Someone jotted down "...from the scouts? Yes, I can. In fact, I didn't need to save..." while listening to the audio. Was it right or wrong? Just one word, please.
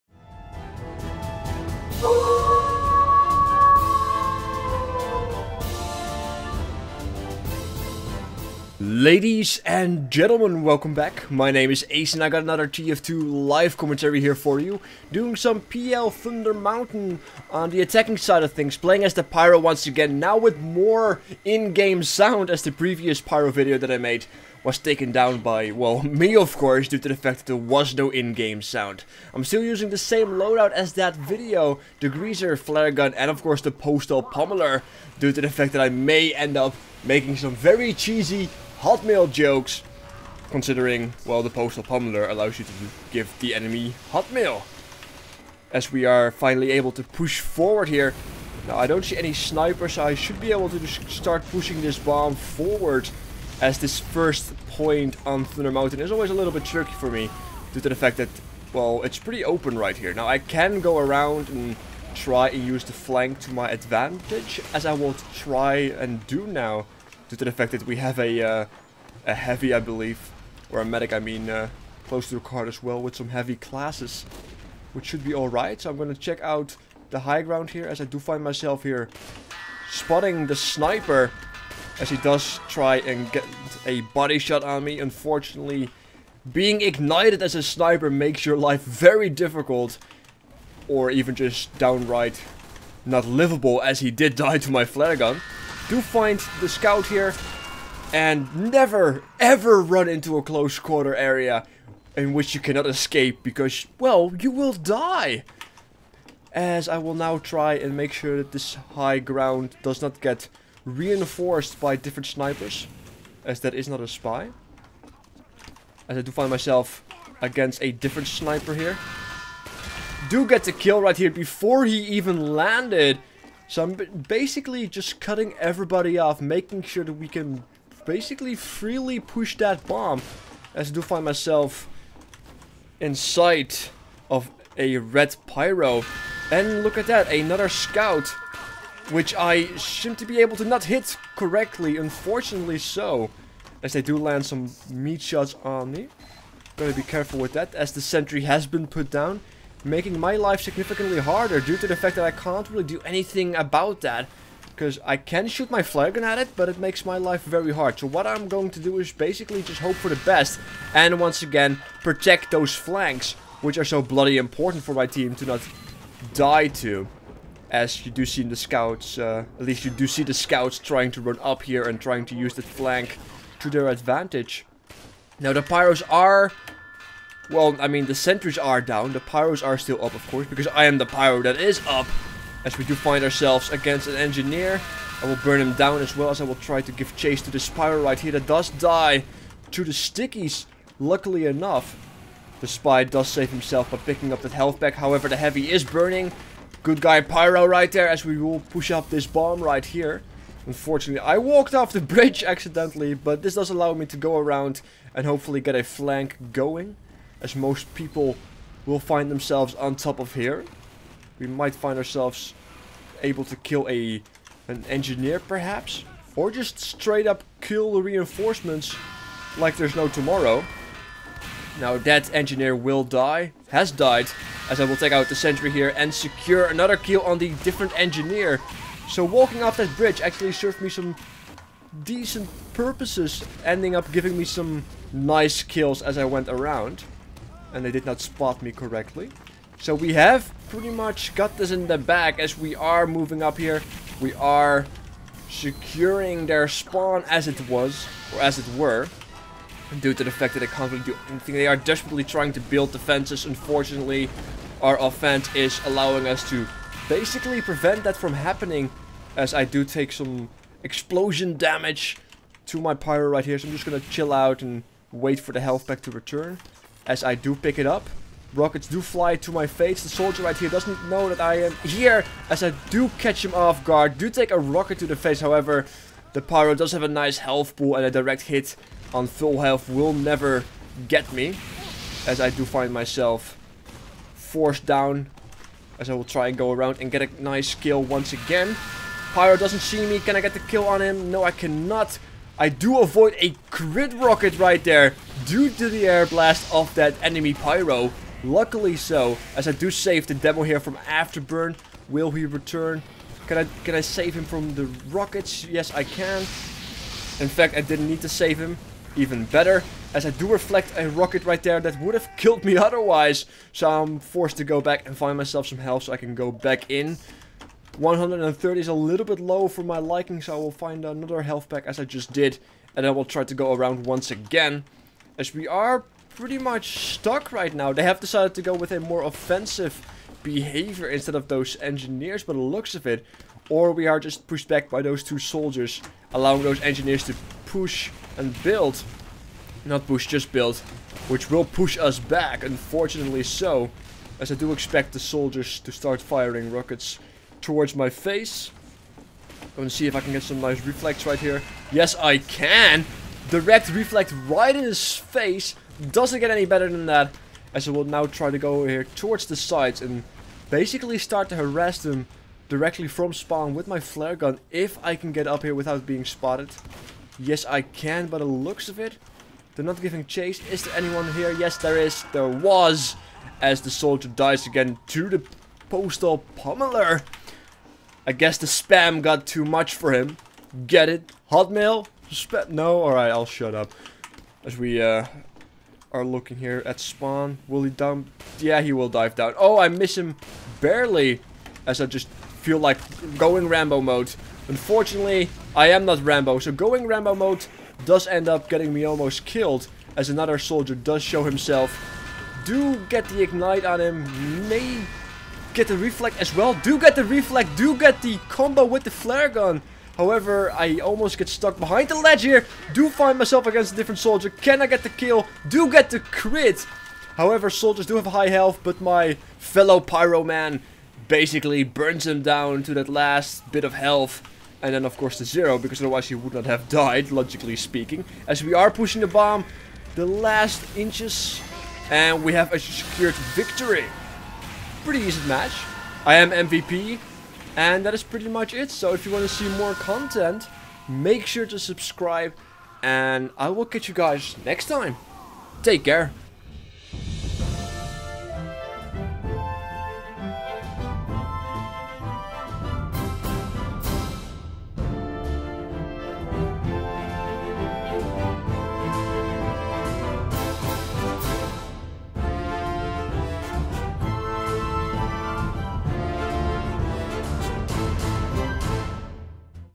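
wrong.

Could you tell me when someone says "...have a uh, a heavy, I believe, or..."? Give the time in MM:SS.
01:07.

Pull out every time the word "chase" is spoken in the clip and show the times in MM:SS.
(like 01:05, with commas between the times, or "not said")
03:07, 06:10.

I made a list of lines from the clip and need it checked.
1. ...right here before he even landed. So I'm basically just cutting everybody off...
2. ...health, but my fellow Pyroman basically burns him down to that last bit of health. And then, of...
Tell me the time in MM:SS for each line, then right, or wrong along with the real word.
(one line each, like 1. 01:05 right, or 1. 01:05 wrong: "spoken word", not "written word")
1. 02:01 right
2. 06:58 right.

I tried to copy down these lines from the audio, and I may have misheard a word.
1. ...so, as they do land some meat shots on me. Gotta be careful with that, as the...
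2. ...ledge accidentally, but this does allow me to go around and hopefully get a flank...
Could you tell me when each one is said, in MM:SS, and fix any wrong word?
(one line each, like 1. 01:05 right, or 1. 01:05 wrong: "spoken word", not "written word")
1. 02:22 right
2. 03:22 wrong: "bridge", not "ledge".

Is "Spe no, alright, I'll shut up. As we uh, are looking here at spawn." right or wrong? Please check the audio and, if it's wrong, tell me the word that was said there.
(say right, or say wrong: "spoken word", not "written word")
right.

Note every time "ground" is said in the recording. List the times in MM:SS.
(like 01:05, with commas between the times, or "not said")
01:17, 01:49.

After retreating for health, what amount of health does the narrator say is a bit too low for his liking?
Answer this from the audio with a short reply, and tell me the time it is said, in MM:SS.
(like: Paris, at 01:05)
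130, at 05:17.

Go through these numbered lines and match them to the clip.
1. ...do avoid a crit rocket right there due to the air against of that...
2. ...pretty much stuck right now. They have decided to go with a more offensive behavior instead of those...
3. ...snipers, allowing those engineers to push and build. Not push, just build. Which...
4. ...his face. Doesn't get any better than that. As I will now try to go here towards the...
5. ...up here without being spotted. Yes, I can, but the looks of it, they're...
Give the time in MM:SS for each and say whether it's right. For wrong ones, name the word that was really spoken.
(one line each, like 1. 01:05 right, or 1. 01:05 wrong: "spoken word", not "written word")
1. 04:52 wrong: "blast", not "against"
2. 05:26 right
3. 05:35 wrong: "soldiers", not "snipers"
4. 05:54 right
5. 06:05 right.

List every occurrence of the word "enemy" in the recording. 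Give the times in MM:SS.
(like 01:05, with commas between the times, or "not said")
00:43, 04:57.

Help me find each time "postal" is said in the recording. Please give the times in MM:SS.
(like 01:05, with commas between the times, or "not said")
00:33, 00:41, 06:15.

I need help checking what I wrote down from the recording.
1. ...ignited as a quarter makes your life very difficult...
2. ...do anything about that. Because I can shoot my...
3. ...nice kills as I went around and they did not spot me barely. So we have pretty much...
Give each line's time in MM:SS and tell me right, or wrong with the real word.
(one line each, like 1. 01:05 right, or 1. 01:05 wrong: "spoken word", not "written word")
1. 01:26 wrong: "sniper", not "quarter"
2. 02:32 right
3. 03:55 wrong: "correctly", not "barely".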